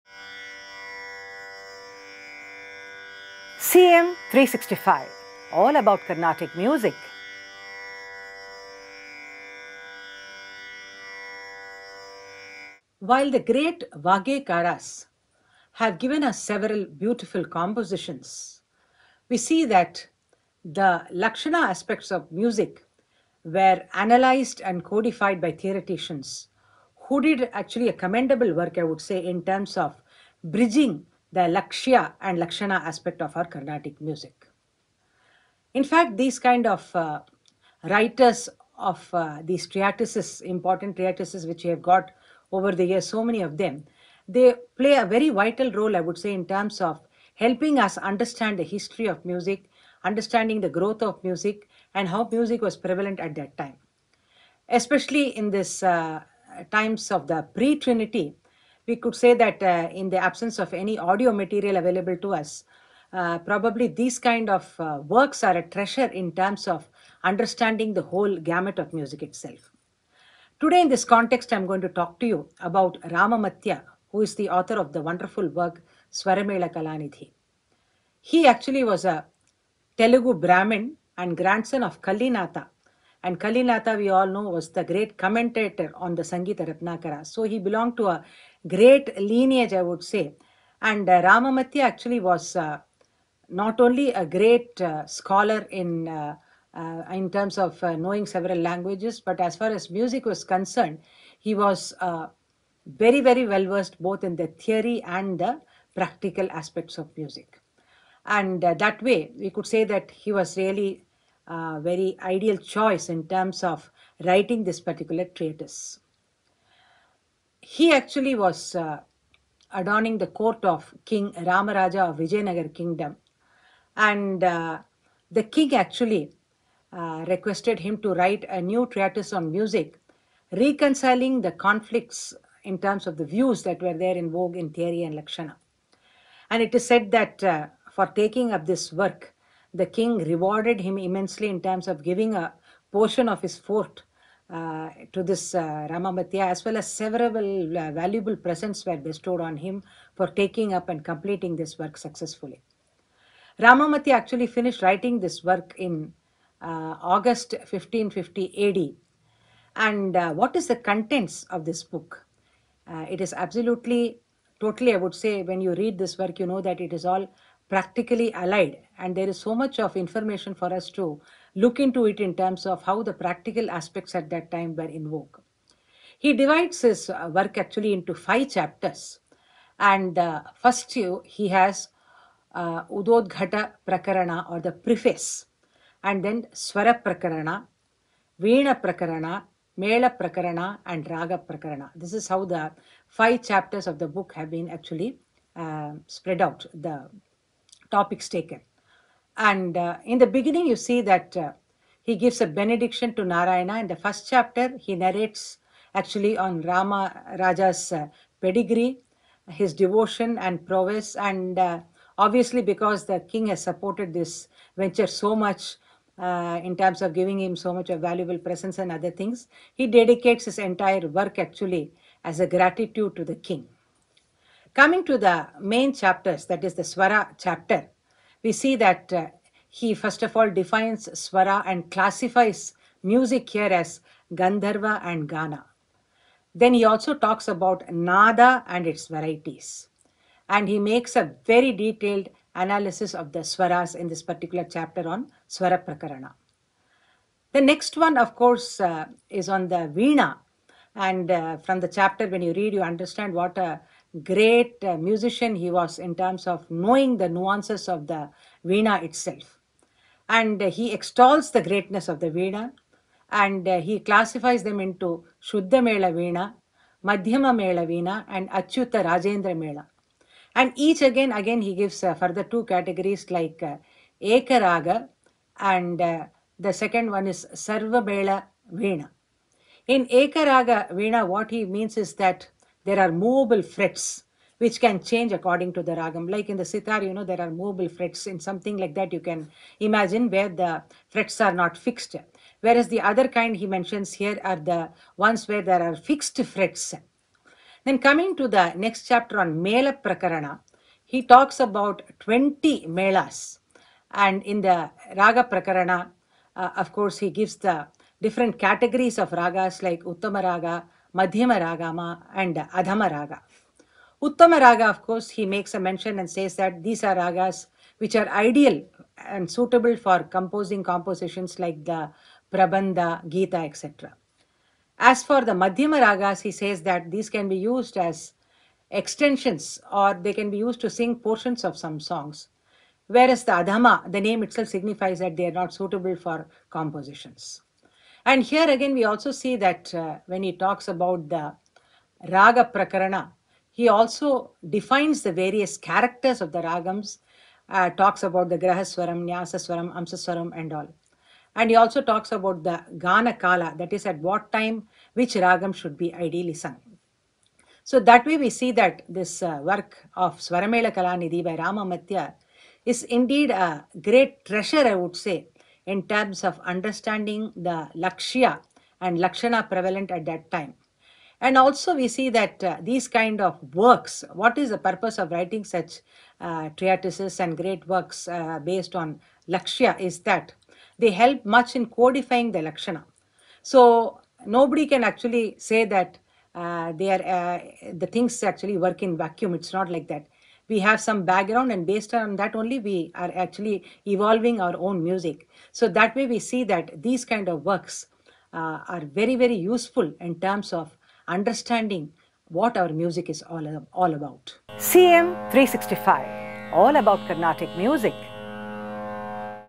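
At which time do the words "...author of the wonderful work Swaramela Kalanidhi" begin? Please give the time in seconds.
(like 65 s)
74 s.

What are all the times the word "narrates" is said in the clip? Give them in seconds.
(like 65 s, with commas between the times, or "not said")
204 s.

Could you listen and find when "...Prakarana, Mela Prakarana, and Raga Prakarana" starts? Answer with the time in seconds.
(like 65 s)
188 s.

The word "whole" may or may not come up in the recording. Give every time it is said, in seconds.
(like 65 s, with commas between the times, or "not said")
68 s.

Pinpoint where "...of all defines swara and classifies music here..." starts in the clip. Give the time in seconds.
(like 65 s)
230 s.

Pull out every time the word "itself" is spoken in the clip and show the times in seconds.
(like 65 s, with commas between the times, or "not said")
69 s, 259 s, 334 s.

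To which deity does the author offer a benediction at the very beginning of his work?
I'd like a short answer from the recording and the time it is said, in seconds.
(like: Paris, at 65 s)
Narayana, at 203 s.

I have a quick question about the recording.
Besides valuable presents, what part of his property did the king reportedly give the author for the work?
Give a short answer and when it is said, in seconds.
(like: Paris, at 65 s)
a portion of his fort, at 142 s.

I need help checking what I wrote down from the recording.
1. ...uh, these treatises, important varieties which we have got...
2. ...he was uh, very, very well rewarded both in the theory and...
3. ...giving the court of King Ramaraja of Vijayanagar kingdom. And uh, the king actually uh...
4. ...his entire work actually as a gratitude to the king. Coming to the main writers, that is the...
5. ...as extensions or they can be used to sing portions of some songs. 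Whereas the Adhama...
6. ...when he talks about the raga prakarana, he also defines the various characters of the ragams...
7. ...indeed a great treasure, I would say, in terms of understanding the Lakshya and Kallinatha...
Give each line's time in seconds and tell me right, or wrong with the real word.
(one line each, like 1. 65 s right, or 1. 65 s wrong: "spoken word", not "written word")
1. 39 s wrong: "treatises", not "varieties"
2. 101 s wrong: "versed", not "rewarded"
3. 119 s wrong: "adorning", not "giving"
4. 220 s wrong: "chapters", not "writers"
5. 327 s right
6. 340 s right
7. 363 s wrong: "Lakshana", not "Kallinatha".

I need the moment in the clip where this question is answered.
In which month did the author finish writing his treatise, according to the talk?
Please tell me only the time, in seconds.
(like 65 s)
157 s.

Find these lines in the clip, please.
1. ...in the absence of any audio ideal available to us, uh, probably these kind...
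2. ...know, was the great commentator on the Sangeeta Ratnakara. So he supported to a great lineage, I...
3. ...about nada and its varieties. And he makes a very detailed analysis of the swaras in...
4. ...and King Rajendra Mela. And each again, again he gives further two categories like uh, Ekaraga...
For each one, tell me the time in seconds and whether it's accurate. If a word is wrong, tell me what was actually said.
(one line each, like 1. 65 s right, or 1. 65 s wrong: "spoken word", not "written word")
1. 60 s wrong: "material", not "ideal"
2. 84 s wrong: "belonged", not "supported"
3. 237 s right
4. 268 s wrong: "Achyuta", not "King".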